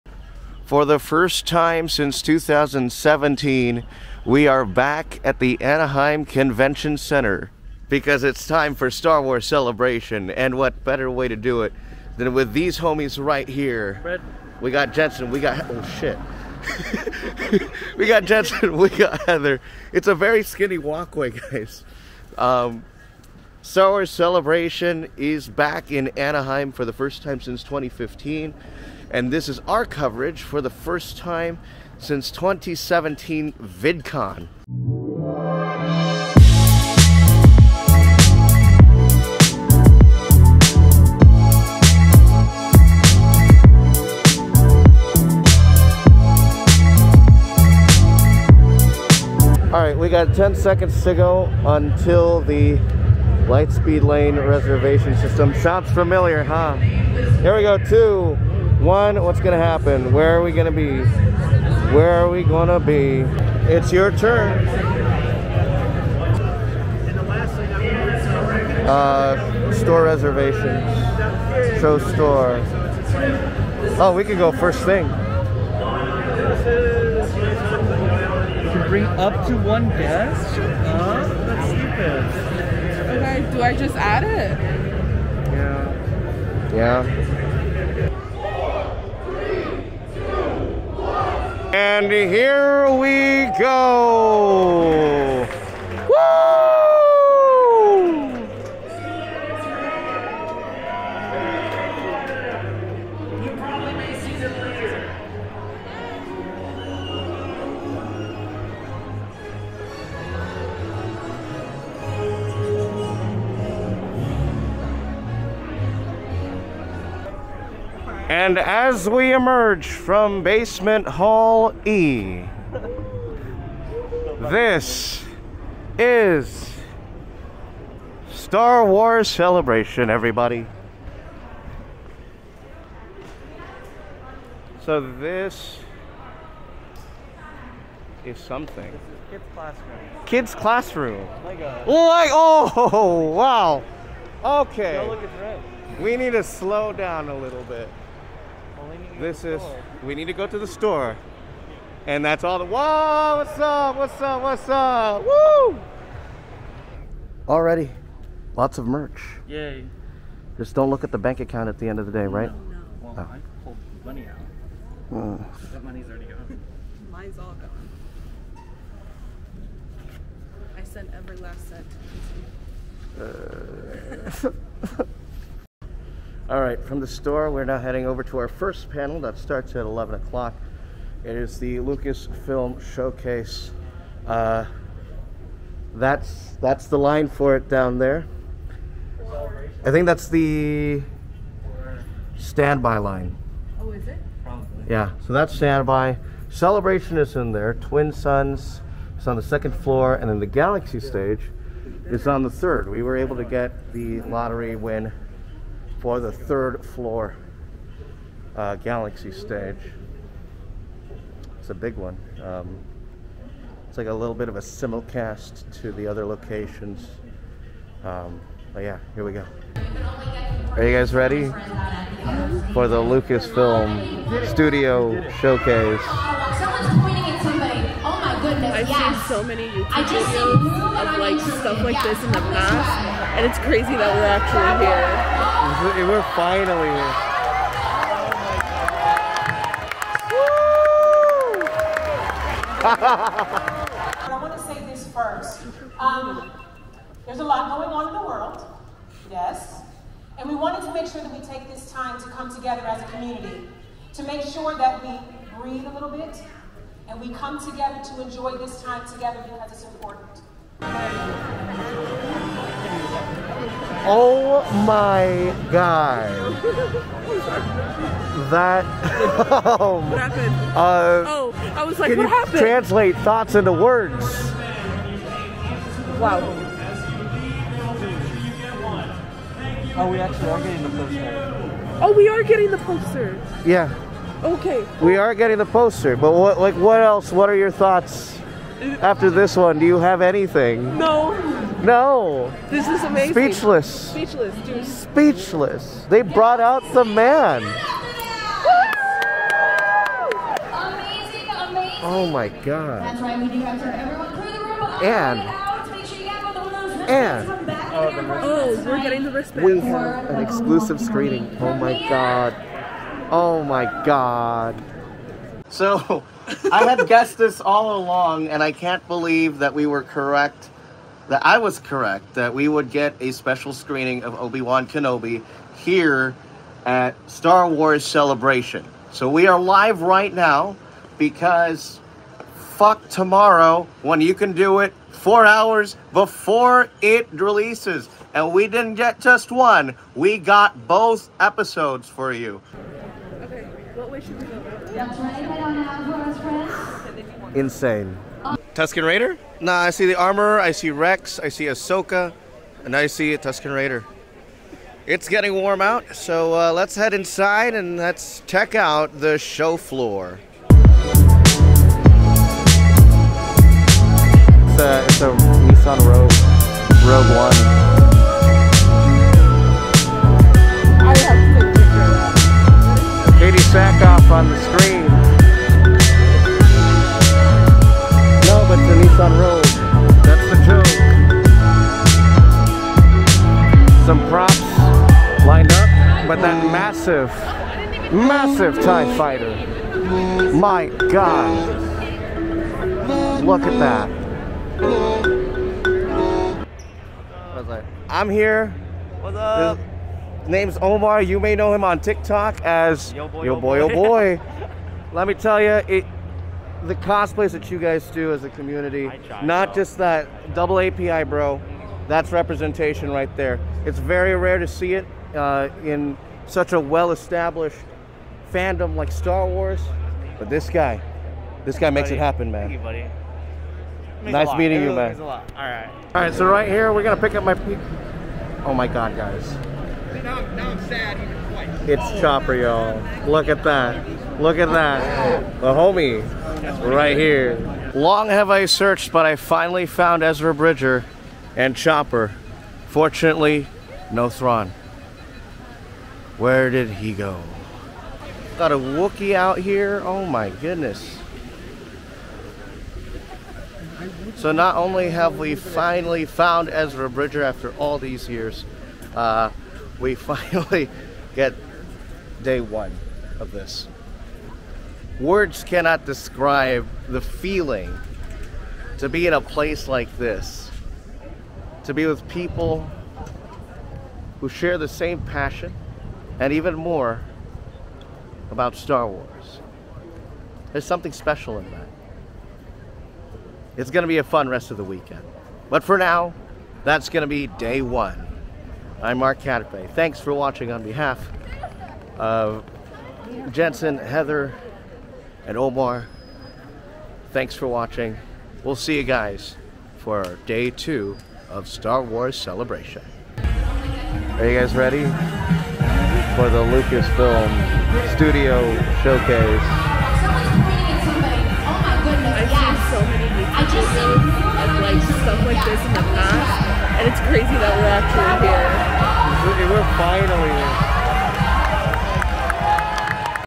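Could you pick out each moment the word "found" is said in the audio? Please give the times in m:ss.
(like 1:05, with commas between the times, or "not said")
7:19, 7:36.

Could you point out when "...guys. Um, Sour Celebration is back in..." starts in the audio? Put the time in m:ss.
0:21.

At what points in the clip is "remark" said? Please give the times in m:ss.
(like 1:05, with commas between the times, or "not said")
not said.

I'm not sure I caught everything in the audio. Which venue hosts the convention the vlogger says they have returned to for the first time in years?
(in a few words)
Anaheim Convention Center.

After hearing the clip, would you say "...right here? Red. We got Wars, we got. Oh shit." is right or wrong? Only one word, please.
wrong.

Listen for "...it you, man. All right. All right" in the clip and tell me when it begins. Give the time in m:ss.
7:04.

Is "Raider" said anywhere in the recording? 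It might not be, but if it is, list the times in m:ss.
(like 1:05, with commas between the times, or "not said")
5:49, 5:53.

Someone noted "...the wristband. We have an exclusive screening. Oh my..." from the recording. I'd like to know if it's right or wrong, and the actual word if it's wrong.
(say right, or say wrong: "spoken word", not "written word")
right.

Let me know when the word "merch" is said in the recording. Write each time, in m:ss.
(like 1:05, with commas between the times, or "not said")
2:38.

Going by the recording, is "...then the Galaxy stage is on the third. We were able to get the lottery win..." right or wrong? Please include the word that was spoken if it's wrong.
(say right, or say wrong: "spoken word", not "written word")
right.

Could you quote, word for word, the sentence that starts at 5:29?
So, we are live right now because fuck tomorrow when you can do it four hours before it releases.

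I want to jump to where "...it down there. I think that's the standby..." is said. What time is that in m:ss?
3:07.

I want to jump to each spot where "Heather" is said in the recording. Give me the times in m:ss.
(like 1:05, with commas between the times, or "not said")
0:19, 8:13.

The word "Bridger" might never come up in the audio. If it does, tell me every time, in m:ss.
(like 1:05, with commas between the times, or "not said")
7:20, 7:37.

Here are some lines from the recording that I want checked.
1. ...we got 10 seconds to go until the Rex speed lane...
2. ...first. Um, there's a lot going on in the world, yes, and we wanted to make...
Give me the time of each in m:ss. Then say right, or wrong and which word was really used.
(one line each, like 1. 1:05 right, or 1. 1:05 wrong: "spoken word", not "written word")
1. 0:49 wrong: "Light", not "Rex"
2. 4:05 right.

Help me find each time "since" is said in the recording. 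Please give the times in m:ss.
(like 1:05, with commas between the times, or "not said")
0:01, 0:27, 0:31.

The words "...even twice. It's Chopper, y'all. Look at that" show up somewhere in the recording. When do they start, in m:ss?
7:11.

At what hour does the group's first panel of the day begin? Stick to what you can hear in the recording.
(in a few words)
11 o'clock.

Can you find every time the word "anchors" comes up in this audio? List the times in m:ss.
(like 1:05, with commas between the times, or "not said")
not said.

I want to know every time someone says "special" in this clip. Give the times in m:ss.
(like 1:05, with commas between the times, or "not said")
5:23, 8:01.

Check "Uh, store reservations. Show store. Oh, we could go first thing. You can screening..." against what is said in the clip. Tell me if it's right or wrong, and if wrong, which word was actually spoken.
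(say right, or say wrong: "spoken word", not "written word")
wrong: "bring", not "screening".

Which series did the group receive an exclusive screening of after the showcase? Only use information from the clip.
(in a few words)
Obi Wan Kenobi.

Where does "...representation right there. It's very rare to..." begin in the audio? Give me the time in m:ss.
6:52.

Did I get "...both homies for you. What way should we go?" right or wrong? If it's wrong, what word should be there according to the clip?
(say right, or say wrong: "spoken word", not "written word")
wrong: "episodes", not "homies".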